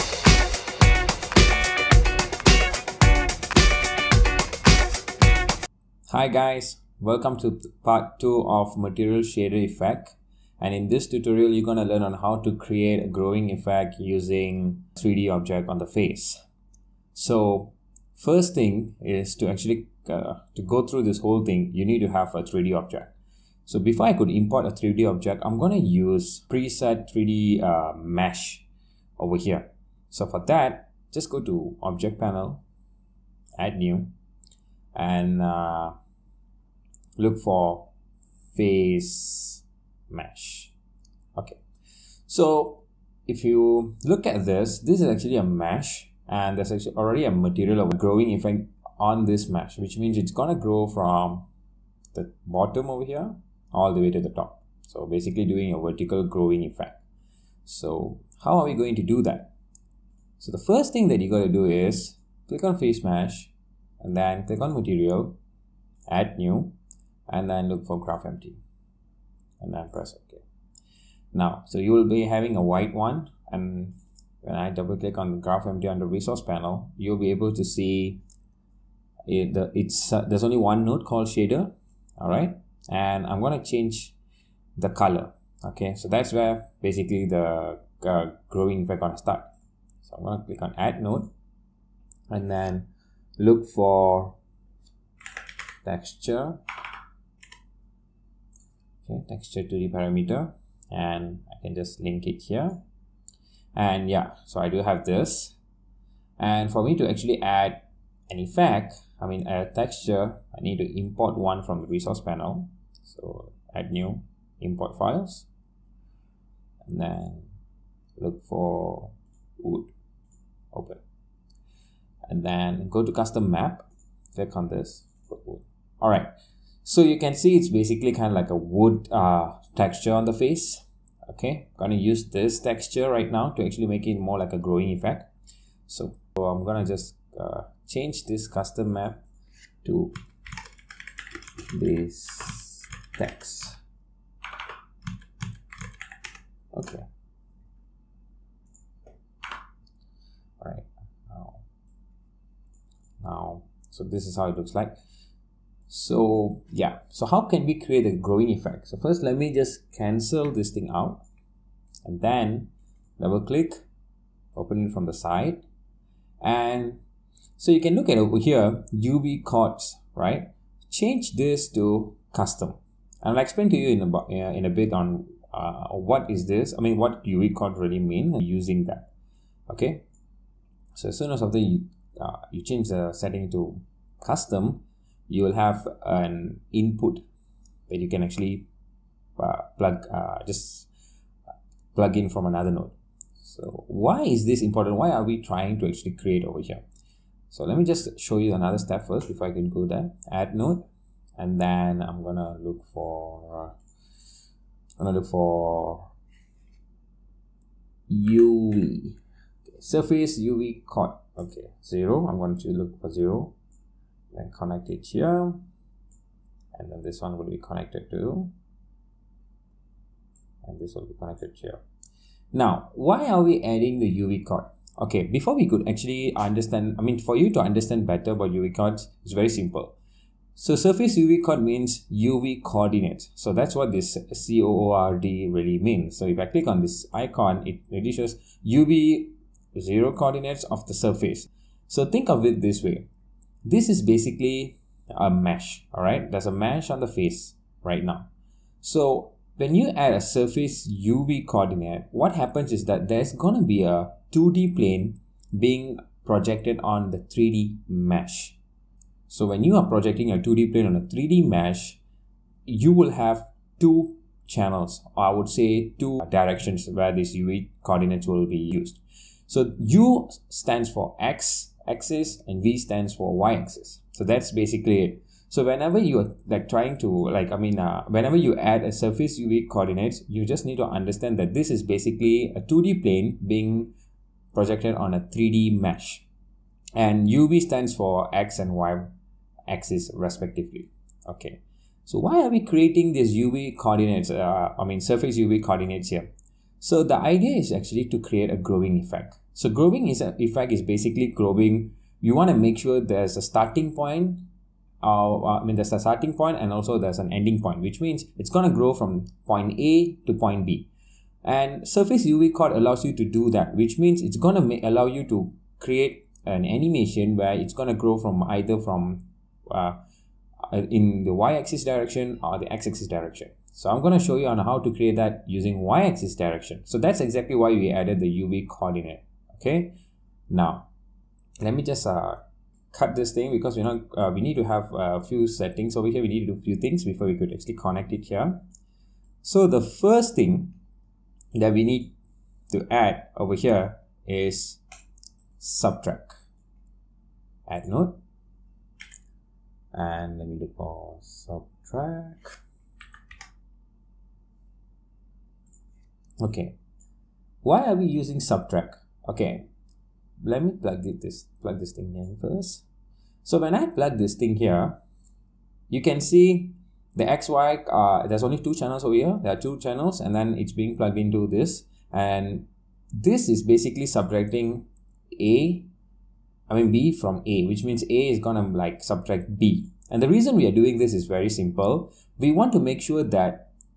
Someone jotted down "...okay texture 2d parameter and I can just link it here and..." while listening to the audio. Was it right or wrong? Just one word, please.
right.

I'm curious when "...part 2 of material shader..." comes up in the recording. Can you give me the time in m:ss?
0:07.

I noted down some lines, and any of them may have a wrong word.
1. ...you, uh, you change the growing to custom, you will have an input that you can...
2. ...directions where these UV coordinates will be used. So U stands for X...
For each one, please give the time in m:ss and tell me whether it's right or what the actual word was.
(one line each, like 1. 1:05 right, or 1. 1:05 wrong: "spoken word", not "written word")
1. 3:01 wrong: "setting", not "growing"
2. 4:26 right.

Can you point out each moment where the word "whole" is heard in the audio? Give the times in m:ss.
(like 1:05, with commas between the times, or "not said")
0:21.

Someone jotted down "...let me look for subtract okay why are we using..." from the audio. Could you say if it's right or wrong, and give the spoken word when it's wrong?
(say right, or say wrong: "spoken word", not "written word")
right.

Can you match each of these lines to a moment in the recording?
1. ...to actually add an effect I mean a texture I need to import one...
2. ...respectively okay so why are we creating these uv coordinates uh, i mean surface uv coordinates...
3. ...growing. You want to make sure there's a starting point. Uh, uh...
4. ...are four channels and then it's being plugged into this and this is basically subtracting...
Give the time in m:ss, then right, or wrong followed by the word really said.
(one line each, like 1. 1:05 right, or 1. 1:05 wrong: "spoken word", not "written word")
1. 1:46 right
2. 4:50 right
3. 5:01 right
4. 6:09 wrong: "two", not "four".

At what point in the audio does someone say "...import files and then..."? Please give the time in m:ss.
1:54.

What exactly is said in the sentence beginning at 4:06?
There's a mesh on the face right now.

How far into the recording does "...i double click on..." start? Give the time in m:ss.
1:14.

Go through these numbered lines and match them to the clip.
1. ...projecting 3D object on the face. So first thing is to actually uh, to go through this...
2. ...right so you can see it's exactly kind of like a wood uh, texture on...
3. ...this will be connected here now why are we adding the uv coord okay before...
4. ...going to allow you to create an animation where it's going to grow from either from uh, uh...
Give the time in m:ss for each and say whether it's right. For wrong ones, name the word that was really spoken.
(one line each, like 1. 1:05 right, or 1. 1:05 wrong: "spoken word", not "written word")
1. 0:13 wrong: "using", not "projecting"
2. 2:06 wrong: "basically", not "exactly"
3. 3:40 right
4. 5:14 right.